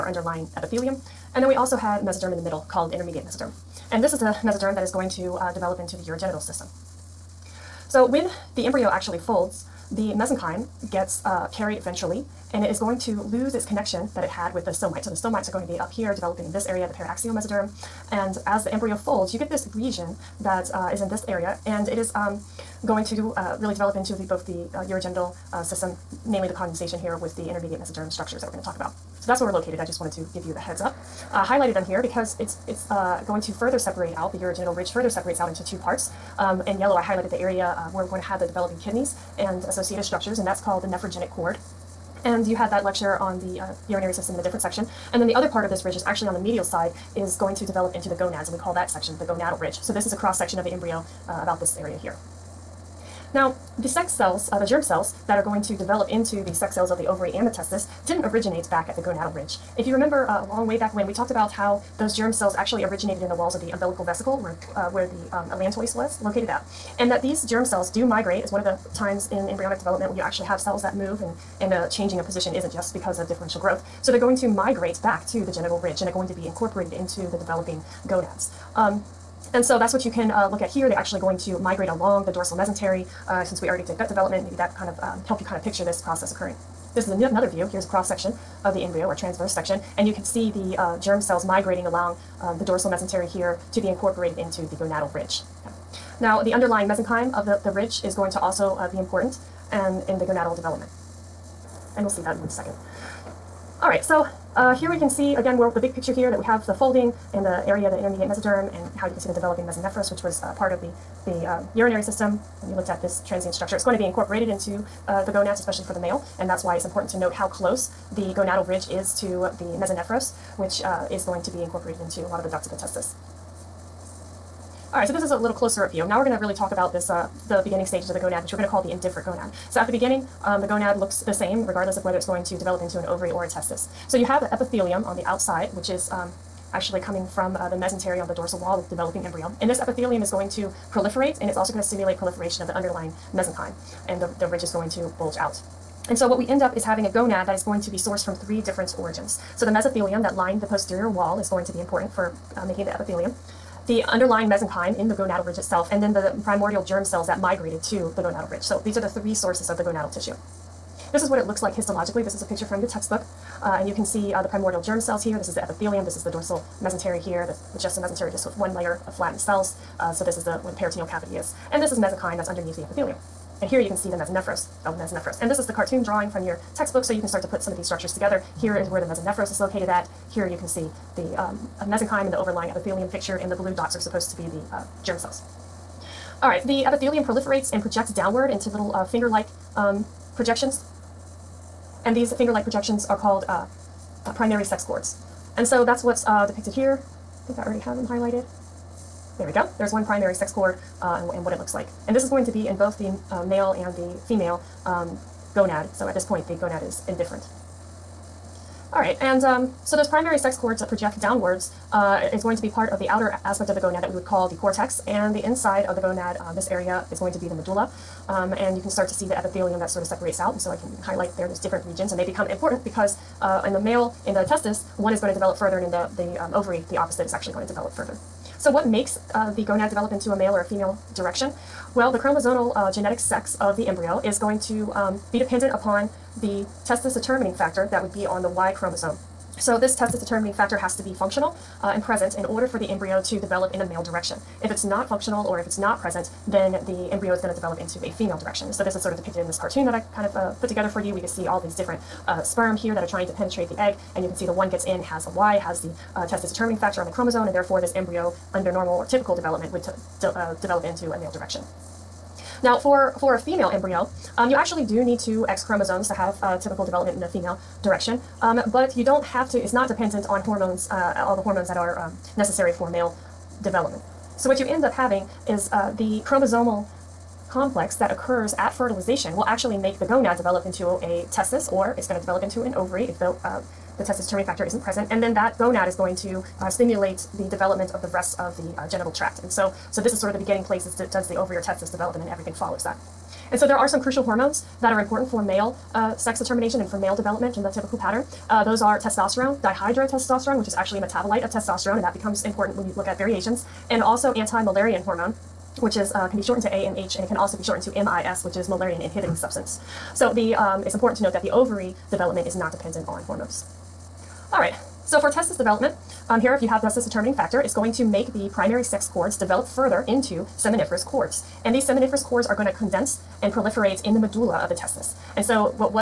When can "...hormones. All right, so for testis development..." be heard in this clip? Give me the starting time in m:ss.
5:13.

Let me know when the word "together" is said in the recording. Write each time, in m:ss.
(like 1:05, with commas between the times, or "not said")
2:58, 4:10.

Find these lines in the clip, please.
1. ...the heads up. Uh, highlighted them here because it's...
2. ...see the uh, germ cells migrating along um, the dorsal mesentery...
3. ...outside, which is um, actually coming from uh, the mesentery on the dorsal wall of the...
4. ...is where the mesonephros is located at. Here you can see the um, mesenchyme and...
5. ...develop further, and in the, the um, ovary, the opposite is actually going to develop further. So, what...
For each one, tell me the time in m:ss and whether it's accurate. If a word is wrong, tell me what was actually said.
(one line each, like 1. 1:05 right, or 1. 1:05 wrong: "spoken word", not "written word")
1. 0:30 right
2. 1:30 right
3. 2:15 right
4. 2:58 right
5. 3:45 right.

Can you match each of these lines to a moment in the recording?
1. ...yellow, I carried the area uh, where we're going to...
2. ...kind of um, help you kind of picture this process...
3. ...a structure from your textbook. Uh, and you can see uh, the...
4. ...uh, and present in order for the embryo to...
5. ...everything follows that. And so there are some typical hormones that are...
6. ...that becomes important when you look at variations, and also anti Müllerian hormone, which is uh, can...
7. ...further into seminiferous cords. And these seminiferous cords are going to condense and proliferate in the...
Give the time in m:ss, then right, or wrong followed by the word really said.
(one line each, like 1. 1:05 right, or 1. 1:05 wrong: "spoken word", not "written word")
1. 0:36 wrong: "highlighted", not "carried"
2. 1:24 right
3. 2:42 wrong: "picture", not "structure"
4. 4:01 right
5. 4:52 wrong: "crucial", not "typical"
6. 5:02 right
7. 5:19 right.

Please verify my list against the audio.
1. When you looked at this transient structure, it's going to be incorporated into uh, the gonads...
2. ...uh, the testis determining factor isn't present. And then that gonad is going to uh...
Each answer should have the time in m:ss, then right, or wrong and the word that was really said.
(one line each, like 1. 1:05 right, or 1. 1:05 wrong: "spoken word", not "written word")
1. 1:52 right
2. 4:43 right.